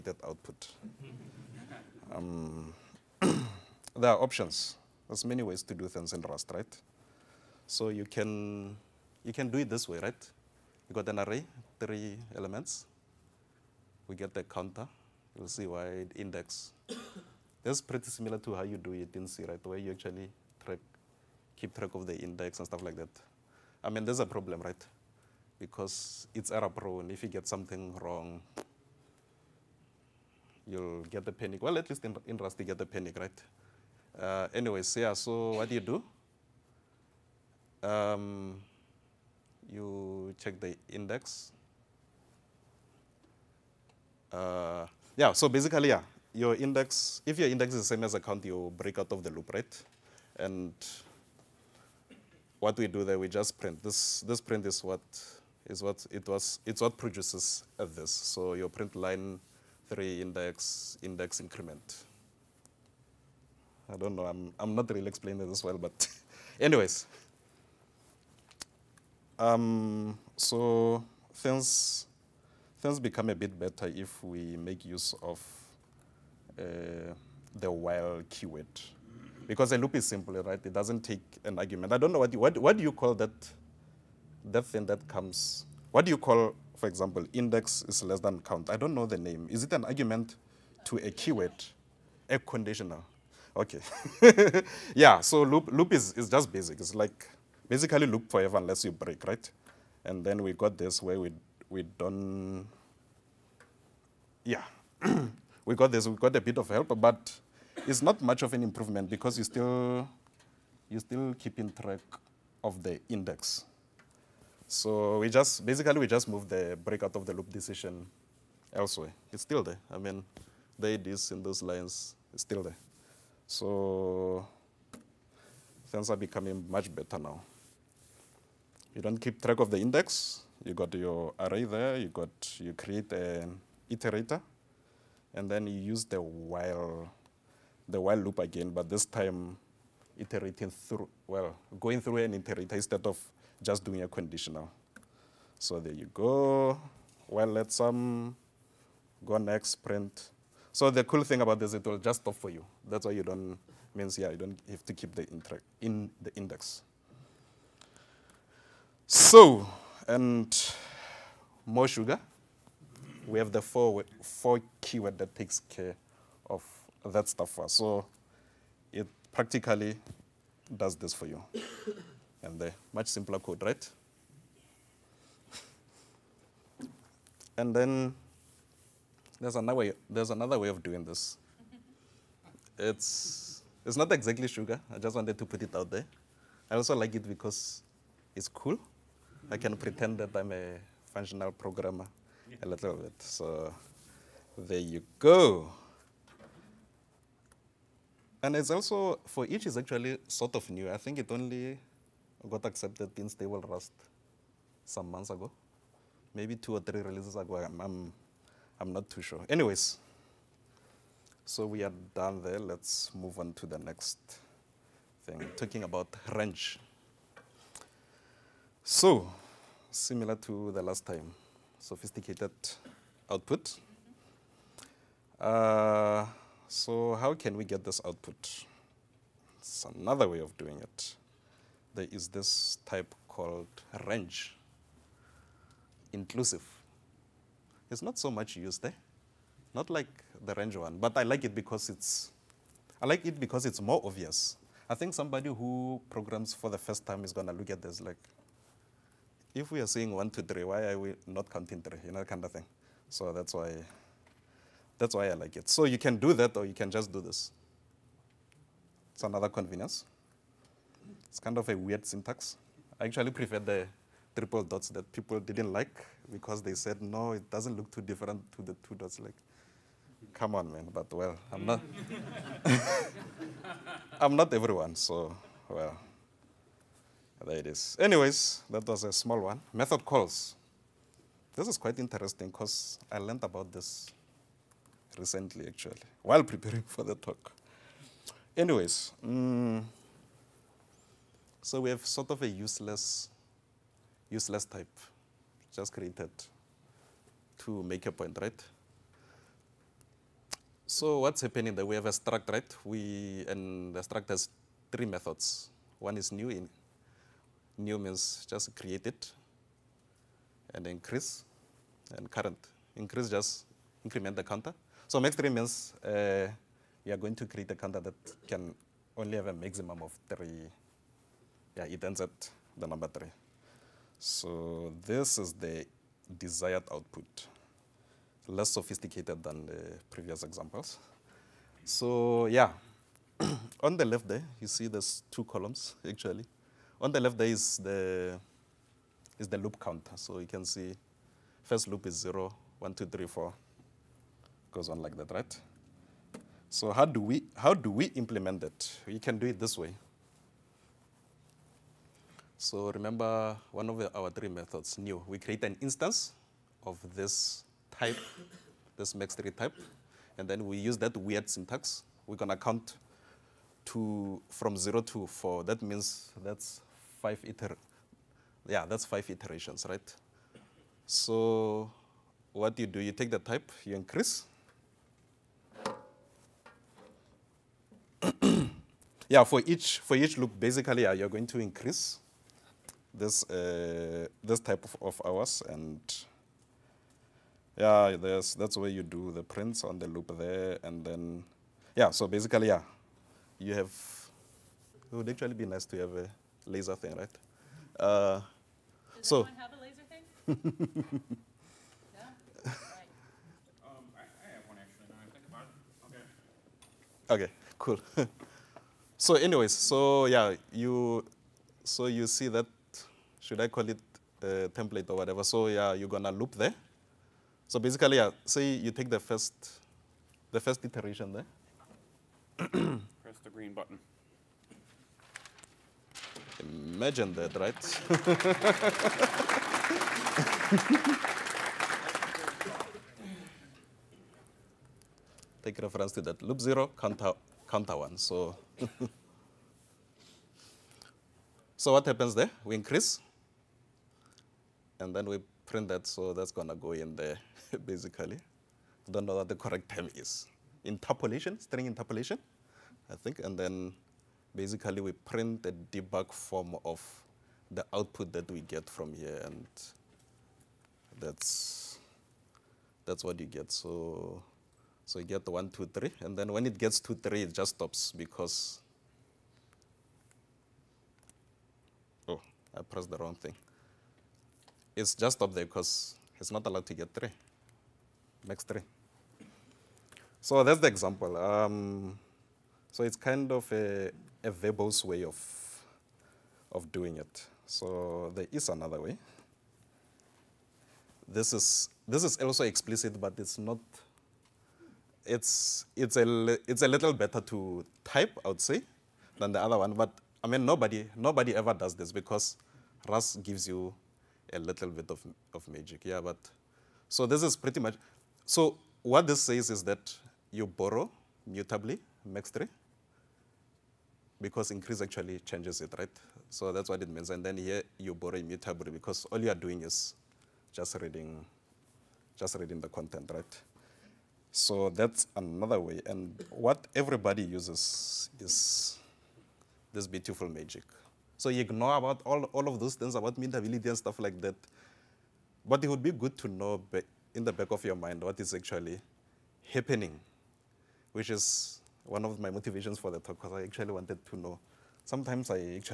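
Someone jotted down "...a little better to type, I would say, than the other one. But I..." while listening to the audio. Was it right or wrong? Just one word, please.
right.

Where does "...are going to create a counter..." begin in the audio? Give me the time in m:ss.
5:17.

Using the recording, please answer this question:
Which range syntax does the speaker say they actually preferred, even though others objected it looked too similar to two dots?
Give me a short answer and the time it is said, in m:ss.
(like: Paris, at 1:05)
triple dots, at 4:24.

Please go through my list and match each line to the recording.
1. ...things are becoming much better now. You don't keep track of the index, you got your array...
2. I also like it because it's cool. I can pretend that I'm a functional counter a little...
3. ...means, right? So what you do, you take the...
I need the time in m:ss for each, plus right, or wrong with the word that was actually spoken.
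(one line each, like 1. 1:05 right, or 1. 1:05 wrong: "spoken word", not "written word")
1. 2:05 right
2. 3:06 wrong: "programmer", not "counter"
3. 6:09 wrong: "iterations", not "means".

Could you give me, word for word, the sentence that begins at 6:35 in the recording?
It would actually be nice to have a laser thing, right?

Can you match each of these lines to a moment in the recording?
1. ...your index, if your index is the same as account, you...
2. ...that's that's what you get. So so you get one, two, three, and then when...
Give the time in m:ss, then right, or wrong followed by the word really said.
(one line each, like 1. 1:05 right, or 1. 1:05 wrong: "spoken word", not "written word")
1. 0:46 right
2. 7:41 right.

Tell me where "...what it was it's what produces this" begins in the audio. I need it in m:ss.
0:55.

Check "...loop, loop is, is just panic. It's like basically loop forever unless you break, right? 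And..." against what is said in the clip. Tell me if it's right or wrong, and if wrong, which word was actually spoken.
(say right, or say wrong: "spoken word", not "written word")
wrong: "basic", not "panic".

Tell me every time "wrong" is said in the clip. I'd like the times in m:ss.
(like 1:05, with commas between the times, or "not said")
0:28, 7:53.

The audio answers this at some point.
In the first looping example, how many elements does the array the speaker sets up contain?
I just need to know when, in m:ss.
0:11.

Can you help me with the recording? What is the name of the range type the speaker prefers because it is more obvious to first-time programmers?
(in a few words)
range inclusive.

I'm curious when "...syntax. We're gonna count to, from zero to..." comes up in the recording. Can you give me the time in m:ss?
6:01.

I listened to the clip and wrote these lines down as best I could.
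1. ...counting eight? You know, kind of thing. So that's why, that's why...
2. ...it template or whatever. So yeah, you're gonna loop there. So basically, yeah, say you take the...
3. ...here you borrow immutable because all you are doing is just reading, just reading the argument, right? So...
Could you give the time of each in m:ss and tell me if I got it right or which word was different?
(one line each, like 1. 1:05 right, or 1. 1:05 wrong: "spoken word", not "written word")
1. 4:11 wrong: "three", not "eight"
2. 6:53 right
3. 8:37 wrong: "content", not "argument".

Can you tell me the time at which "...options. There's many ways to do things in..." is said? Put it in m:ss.
0:04.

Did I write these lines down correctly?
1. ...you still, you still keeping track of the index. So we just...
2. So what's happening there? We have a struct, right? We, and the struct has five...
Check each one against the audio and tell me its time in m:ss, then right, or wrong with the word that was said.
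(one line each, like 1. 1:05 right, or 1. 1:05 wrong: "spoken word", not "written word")
1. 1:49 right
2. 5:00 wrong: "three", not "five".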